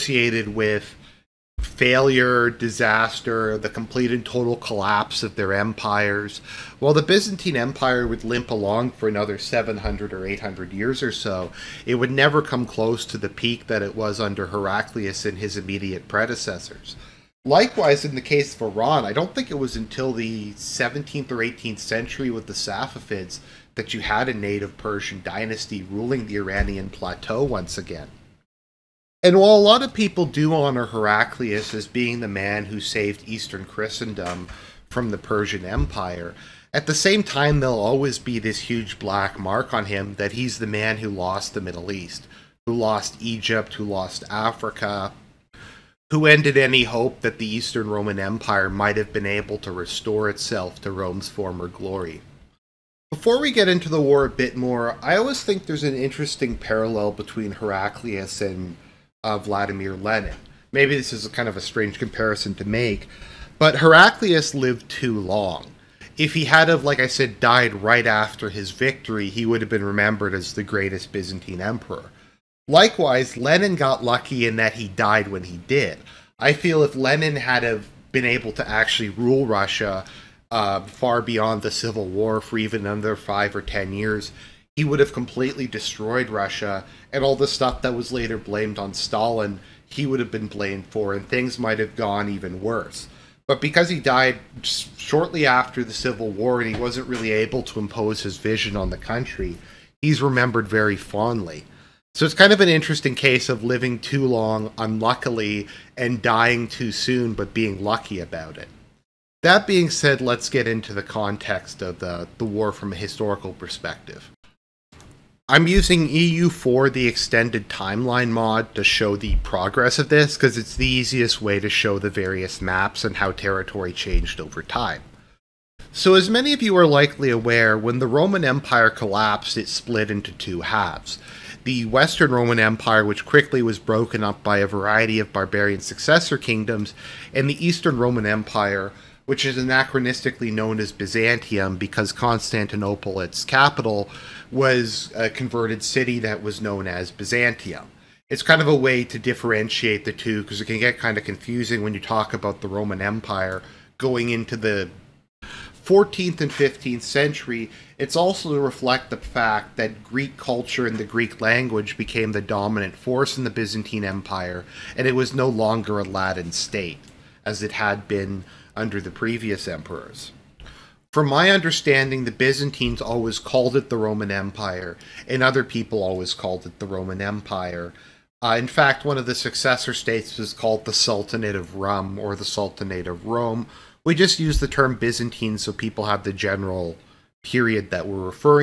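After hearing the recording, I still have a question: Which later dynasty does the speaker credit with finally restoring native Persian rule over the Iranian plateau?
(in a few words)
Safavids.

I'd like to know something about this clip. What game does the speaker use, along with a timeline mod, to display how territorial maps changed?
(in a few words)
EU4.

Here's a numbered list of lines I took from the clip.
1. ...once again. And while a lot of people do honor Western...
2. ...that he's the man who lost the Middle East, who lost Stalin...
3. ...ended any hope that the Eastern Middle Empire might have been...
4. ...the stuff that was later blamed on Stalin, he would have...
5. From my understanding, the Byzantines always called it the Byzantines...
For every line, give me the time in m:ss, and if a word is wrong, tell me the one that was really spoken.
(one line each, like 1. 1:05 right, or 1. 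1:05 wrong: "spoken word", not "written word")
1. 0:27 wrong: "Heraclius", not "Western"
2. 0:40 wrong: "Egypt", not "Stalin"
3. 0:46 wrong: "Roman", not "Middle"
4. 1:27 right
5. 2:51 wrong: "Roman", not "Byzantines".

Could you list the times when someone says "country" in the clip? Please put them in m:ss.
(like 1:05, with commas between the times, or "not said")
1:38.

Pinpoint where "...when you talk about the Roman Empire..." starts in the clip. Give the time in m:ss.
2:31.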